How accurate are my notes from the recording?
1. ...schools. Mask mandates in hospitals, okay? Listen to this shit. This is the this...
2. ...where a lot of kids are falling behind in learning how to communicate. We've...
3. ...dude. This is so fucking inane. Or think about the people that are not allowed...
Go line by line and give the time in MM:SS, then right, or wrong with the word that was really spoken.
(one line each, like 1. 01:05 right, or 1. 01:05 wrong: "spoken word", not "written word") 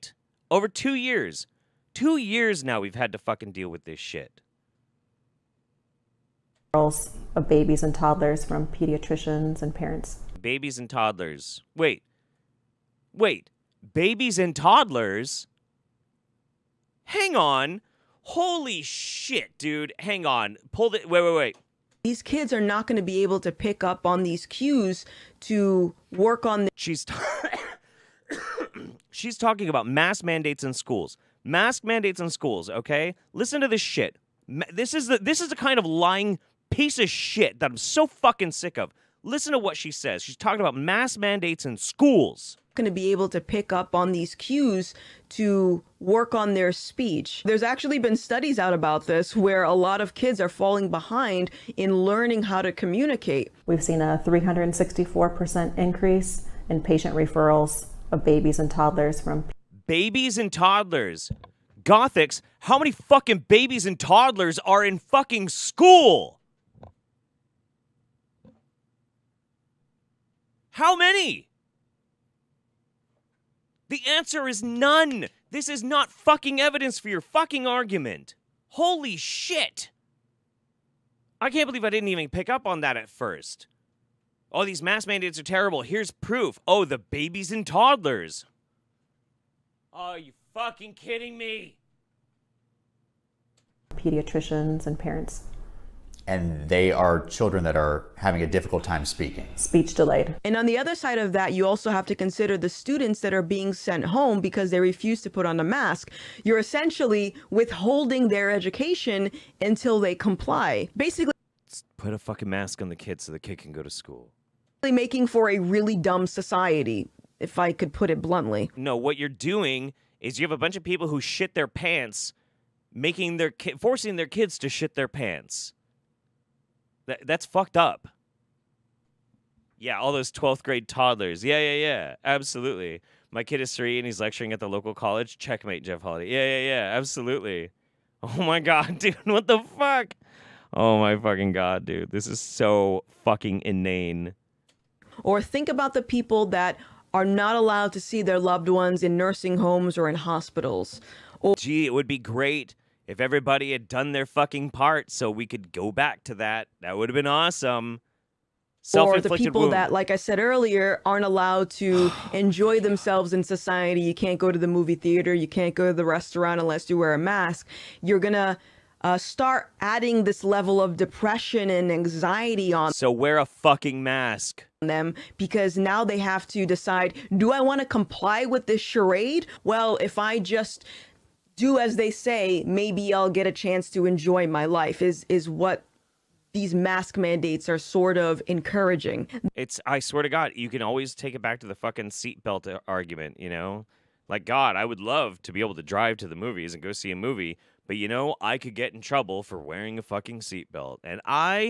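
1. 00:30 wrong: "schools", not "hospitals"
2. 00:49 right
3. 02:21 right.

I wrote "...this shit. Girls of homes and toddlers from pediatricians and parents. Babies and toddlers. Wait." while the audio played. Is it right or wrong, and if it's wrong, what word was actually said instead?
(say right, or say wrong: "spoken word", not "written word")
wrong: "babies", not "homes".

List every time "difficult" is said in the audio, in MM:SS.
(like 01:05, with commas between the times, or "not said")
01:38.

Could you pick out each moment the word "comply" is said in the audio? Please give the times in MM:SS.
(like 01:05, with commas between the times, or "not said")
01:50, 02:57.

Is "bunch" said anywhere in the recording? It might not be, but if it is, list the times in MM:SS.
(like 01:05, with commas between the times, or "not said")
02:00.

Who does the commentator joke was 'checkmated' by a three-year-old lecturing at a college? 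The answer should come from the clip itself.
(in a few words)
Jeff Holiday.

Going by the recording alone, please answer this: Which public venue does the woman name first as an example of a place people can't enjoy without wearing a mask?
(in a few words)
movie theater.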